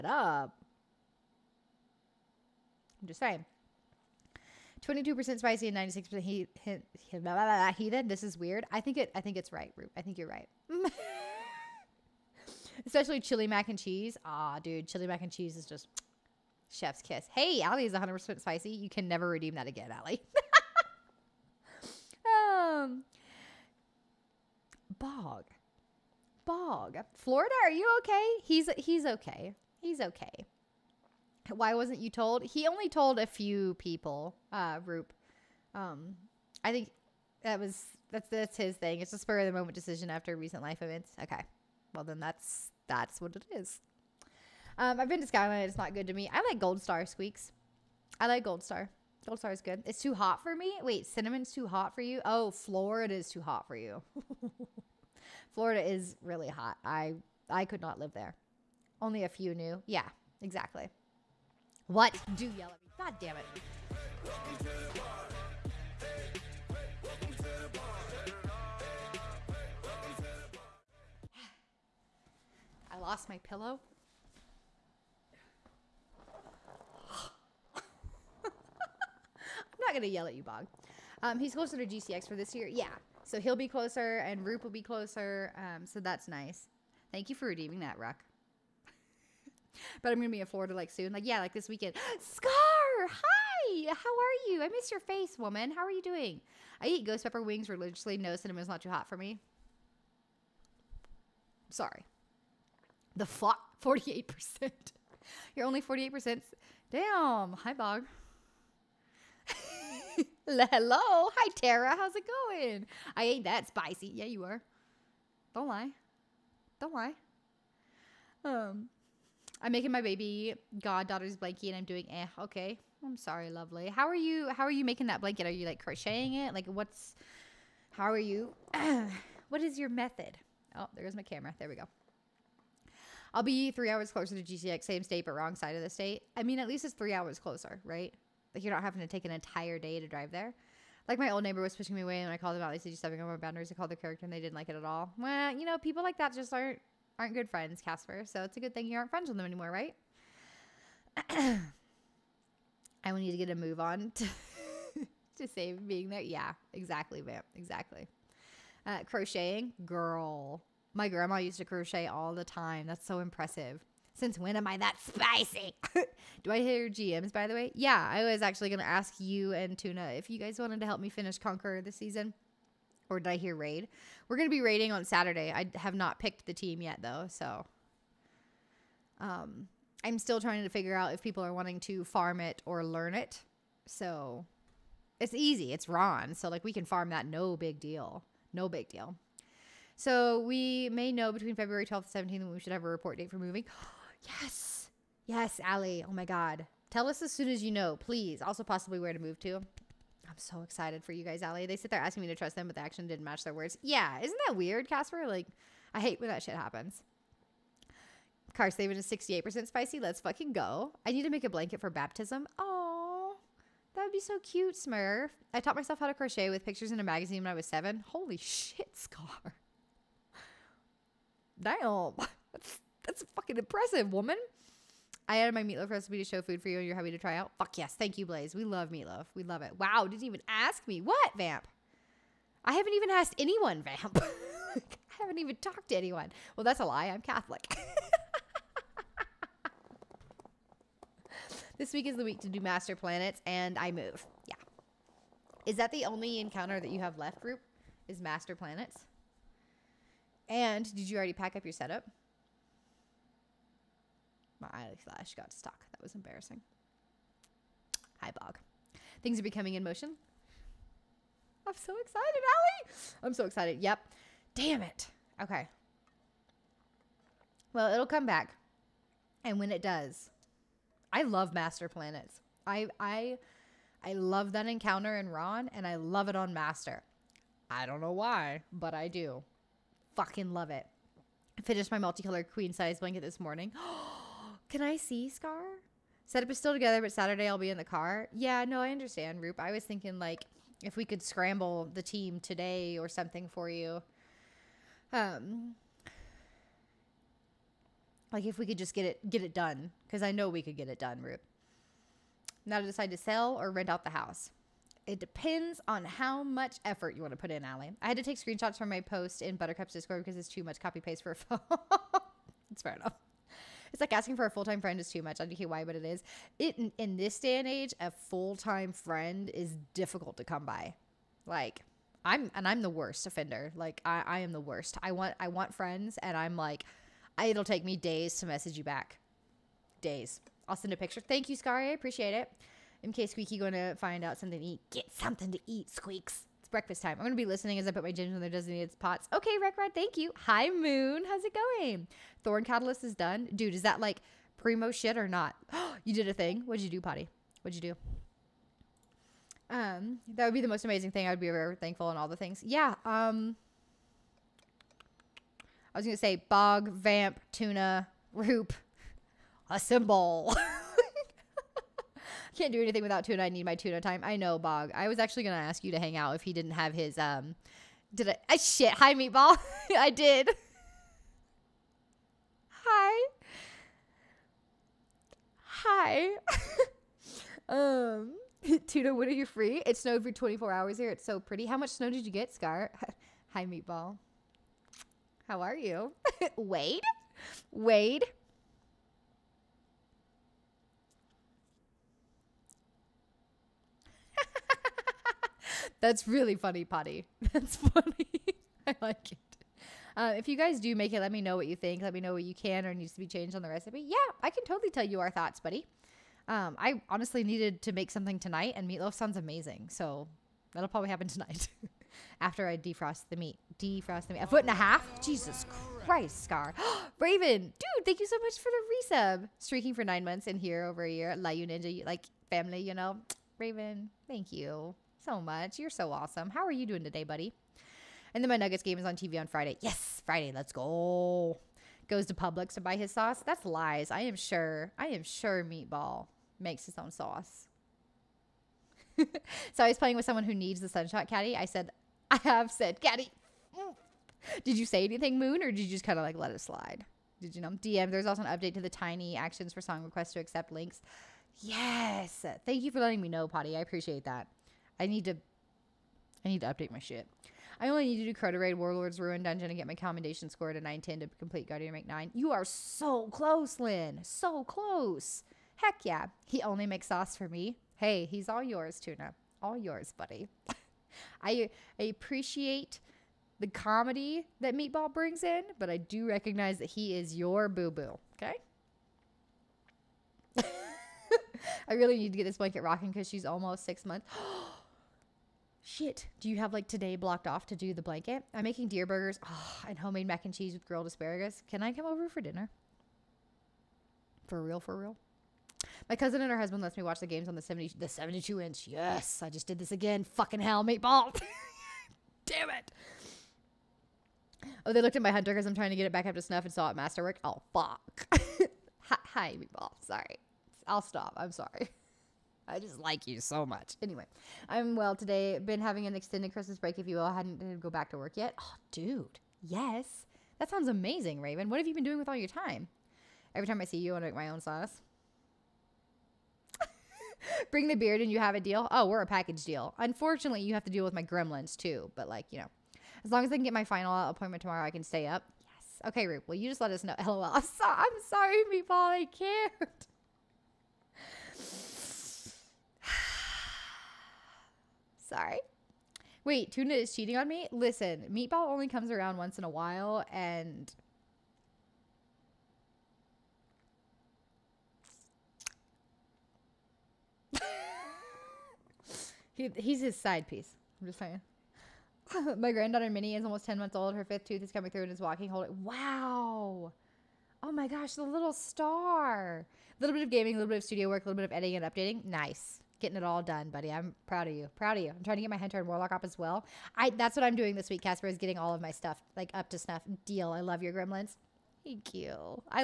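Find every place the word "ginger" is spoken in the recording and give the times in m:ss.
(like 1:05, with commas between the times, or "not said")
5:38.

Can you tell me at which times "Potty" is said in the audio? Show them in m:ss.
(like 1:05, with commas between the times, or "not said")
5:46, 6:36, 7:33.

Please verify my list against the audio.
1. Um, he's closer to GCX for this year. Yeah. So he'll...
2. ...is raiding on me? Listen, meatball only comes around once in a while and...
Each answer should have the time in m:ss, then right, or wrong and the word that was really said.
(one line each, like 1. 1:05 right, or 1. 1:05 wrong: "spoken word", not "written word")
1. 1:21 right
2. 9:06 wrong: "cheating", not "raiding".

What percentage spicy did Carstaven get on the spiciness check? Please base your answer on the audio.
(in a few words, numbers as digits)
68%.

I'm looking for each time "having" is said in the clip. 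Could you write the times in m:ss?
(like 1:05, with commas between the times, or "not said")
2:18, 8:35.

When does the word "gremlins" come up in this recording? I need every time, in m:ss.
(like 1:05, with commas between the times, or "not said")
8:51, 9:40.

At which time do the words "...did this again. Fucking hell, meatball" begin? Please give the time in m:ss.
8:19.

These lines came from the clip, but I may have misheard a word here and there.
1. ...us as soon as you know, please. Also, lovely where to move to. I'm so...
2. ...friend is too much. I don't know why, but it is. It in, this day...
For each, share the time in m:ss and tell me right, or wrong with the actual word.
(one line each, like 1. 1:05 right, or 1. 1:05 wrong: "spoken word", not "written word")
1. 3:17 wrong: "possibly", not "lovely"
2. 5:14 right.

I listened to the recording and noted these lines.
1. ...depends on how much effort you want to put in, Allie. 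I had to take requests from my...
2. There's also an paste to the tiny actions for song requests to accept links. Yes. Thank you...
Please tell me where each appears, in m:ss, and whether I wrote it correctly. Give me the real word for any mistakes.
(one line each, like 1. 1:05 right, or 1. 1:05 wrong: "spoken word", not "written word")
1. 5:05 wrong: "screenshots", not "requests"
2. 7:28 wrong: "update", not "paste".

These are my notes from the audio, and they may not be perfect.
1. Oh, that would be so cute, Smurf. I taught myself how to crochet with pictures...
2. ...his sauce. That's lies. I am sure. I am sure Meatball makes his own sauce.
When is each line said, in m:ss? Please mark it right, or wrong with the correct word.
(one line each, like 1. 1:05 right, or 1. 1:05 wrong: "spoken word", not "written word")
1. 3:32 right
2. 7:12 right.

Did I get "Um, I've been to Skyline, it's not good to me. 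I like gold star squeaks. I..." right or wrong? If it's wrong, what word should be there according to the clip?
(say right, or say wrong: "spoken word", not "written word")
right.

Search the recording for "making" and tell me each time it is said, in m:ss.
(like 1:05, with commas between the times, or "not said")
1:59, 2:04, 8:08.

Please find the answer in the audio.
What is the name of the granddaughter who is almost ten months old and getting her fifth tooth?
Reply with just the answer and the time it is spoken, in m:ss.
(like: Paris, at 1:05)
Minnie, at 9:23.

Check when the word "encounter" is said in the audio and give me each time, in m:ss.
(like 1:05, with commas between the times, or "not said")
4:06, 4:34.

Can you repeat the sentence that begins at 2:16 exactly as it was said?
I mean, at least it's three hours closer, right?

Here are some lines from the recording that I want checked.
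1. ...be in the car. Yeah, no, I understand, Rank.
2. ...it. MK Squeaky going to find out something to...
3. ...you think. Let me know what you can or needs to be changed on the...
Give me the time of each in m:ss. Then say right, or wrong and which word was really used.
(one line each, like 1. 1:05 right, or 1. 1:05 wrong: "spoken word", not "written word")
1. 4:47 wrong: "Roop", not "Rank"
2. 5:32 right
3. 6:41 right.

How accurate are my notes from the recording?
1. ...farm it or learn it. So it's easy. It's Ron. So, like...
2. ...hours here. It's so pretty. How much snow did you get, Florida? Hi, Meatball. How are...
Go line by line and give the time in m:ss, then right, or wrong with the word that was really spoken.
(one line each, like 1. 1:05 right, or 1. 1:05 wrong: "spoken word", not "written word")
1. 3:02 right
2. 6:20 wrong: "Scar", not "Florida".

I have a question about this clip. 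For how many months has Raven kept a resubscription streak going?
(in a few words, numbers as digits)
9.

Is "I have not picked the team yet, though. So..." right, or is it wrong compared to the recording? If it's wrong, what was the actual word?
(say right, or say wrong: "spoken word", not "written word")
right.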